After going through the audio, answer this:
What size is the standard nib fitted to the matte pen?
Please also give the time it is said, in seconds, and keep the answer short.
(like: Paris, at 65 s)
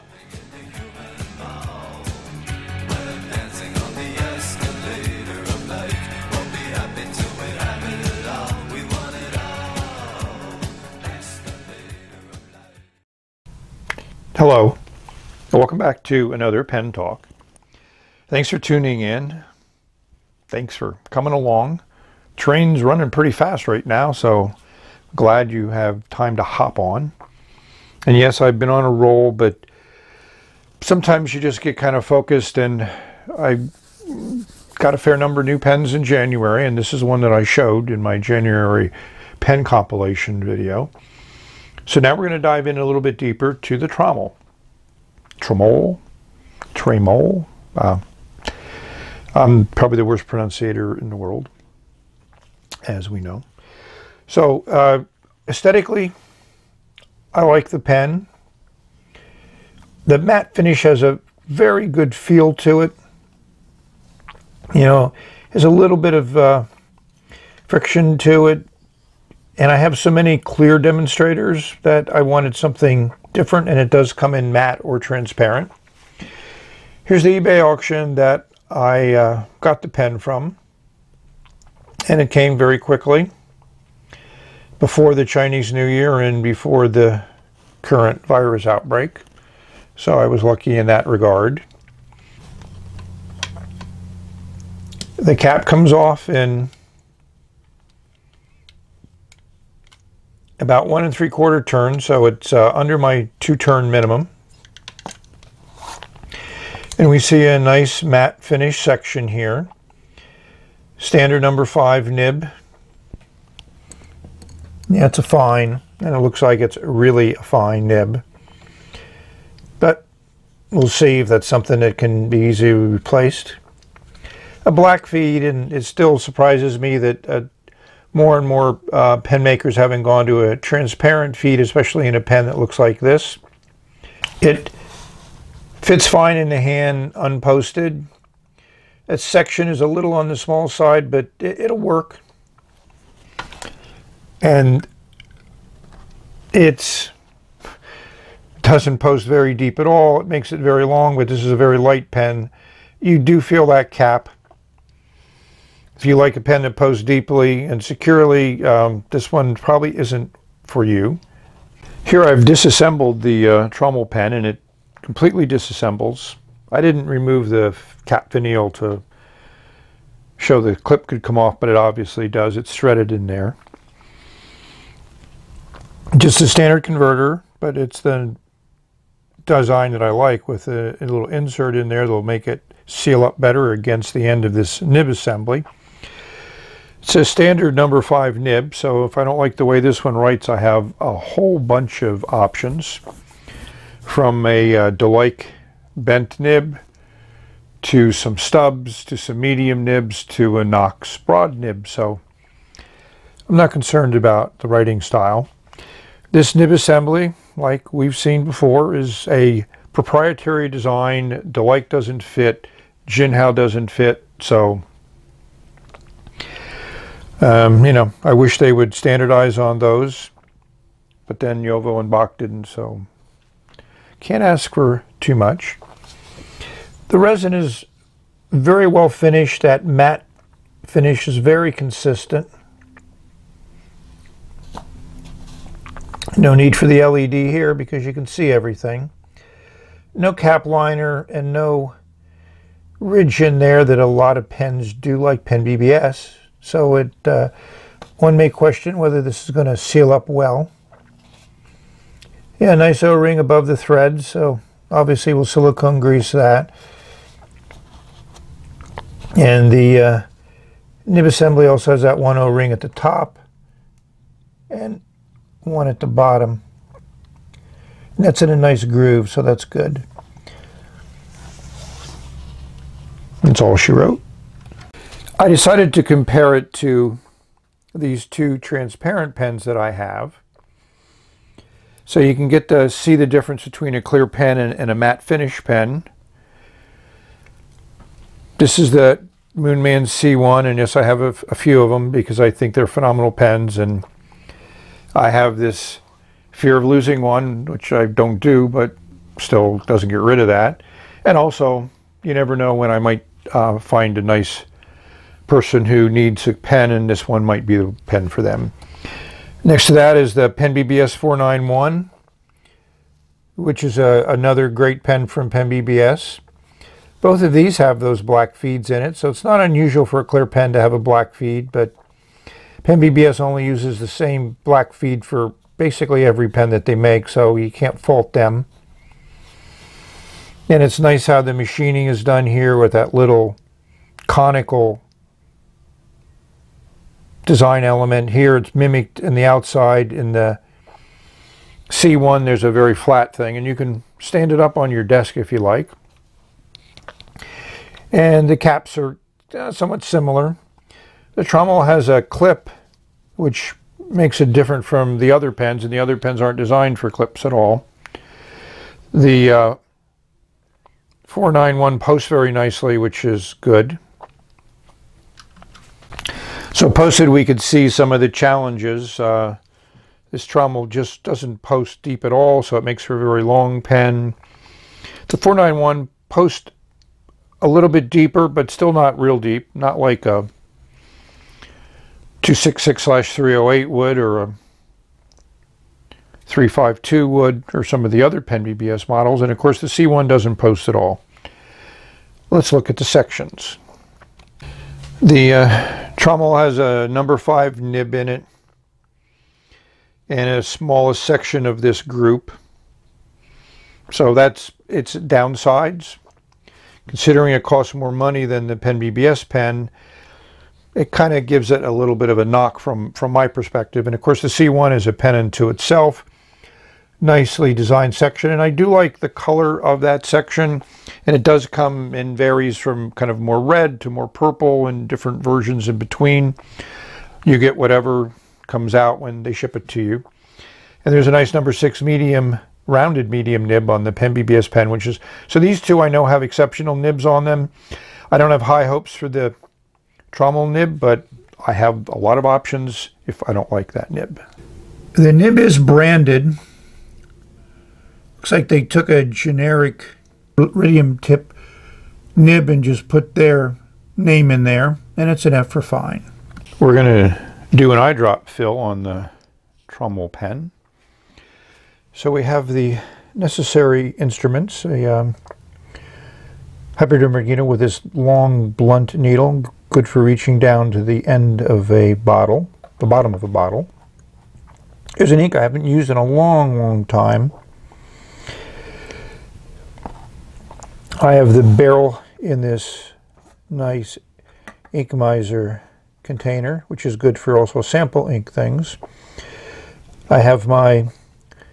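Number 5, at 111 s.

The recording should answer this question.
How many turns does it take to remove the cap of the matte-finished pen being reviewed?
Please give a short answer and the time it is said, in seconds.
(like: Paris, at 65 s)
1 3/4, at 100 s.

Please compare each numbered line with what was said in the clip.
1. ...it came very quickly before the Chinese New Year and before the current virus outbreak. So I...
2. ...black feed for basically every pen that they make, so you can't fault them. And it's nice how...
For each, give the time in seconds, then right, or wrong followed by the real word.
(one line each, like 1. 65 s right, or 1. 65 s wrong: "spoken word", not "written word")
1. 82 s right
2. 324 s right.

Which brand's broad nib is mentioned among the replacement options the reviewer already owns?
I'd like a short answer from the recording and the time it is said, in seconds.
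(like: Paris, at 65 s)
Knox, at 200 s.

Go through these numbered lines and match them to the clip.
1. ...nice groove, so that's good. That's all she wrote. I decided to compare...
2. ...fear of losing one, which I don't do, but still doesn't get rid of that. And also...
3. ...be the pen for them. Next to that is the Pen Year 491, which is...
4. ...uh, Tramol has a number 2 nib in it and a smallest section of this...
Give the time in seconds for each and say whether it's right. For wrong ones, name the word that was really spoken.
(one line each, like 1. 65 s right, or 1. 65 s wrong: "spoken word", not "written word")
1. 268 s right
2. 296 s right
3. 307 s wrong: "BBS", not "Year"
4. 395 s wrong: "5", not "2".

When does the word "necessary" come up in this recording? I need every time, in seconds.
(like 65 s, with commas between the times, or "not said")
463 s.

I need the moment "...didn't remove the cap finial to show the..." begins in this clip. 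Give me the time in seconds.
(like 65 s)
166 s.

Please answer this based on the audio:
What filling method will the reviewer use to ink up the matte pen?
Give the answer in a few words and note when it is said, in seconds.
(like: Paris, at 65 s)
Eyedrop fill, at 458 s.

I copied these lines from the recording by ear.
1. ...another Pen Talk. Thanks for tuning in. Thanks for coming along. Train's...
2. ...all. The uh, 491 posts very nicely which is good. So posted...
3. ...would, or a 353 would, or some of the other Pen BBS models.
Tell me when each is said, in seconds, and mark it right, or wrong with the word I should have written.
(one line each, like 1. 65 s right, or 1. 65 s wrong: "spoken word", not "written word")
1. 16 s right
2. 357 s right
3. 383 s wrong: "352", not "353".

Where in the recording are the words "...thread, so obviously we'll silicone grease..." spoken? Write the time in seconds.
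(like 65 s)
253 s.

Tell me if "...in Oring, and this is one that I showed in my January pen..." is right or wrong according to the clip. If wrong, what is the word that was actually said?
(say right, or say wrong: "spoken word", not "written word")
wrong: "January", not "Oring".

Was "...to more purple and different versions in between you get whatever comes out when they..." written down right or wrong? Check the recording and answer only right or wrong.
right.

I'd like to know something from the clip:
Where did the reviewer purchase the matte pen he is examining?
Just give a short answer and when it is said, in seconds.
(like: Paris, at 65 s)
eBay, at 77 s.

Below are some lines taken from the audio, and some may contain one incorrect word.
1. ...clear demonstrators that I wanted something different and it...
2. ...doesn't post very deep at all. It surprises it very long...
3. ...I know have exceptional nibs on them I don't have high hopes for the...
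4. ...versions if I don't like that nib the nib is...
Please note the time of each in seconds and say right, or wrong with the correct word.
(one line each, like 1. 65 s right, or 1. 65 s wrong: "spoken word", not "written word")
1. 70 s right
2. 148 s wrong: "makes", not "surprises"
3. 436 s right
4. 442 s wrong: "options", not "versions".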